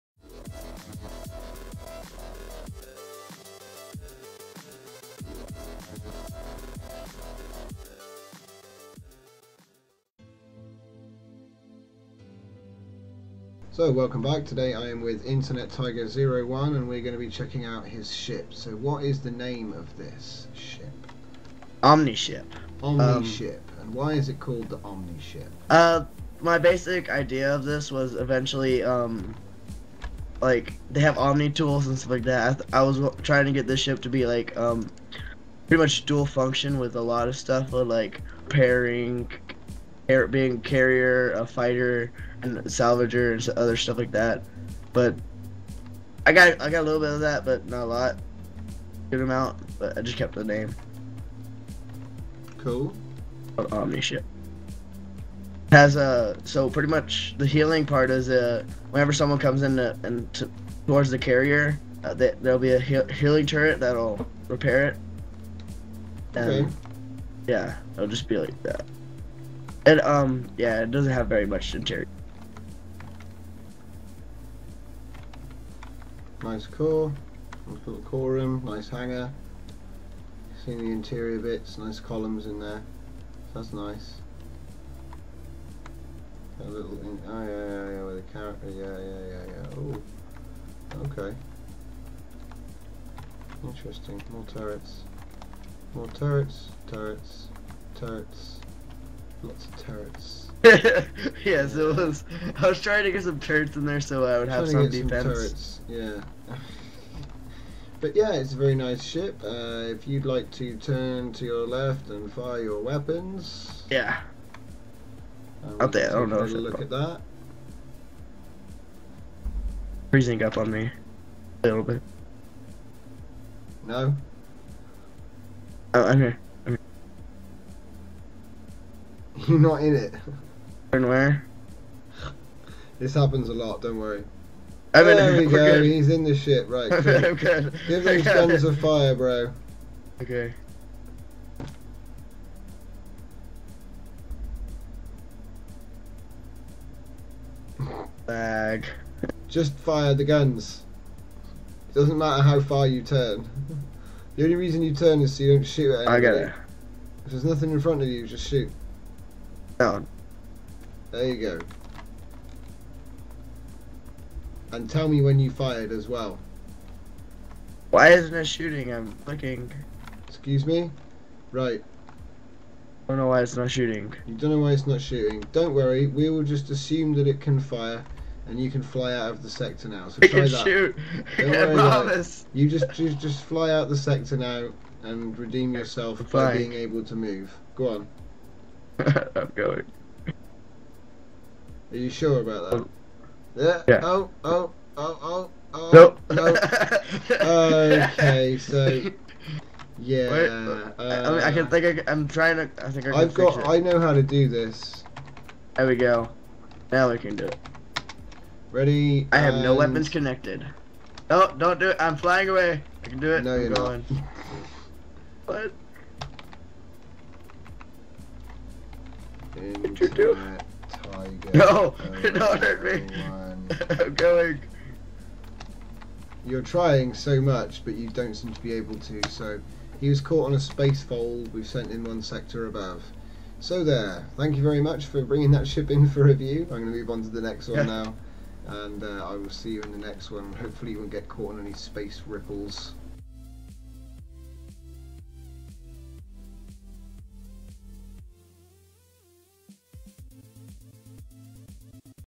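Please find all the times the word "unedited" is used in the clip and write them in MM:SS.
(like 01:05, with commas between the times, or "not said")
not said.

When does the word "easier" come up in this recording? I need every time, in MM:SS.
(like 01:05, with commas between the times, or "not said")
not said.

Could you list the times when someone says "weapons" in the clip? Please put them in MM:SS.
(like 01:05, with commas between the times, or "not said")
01:52, 03:29.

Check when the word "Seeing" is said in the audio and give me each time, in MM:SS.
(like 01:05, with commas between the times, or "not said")
01:20.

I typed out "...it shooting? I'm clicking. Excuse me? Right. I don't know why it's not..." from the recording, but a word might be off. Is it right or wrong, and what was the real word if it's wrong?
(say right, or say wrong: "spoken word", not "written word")
right.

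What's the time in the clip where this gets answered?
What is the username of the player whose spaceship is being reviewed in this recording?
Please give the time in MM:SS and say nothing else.
00:15.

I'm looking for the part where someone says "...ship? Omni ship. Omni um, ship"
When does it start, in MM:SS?
00:20.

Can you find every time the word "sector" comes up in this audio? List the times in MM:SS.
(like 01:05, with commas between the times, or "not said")
02:59, 03:03, 03:52.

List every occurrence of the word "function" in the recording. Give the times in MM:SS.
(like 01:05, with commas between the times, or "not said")
00:36.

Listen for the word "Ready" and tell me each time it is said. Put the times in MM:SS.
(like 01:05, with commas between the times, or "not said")
03:28.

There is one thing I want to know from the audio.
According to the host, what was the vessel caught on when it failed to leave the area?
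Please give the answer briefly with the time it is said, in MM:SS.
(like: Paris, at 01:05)
A space fold, at 03:50.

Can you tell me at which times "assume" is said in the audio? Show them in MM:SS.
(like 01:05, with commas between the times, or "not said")
02:56.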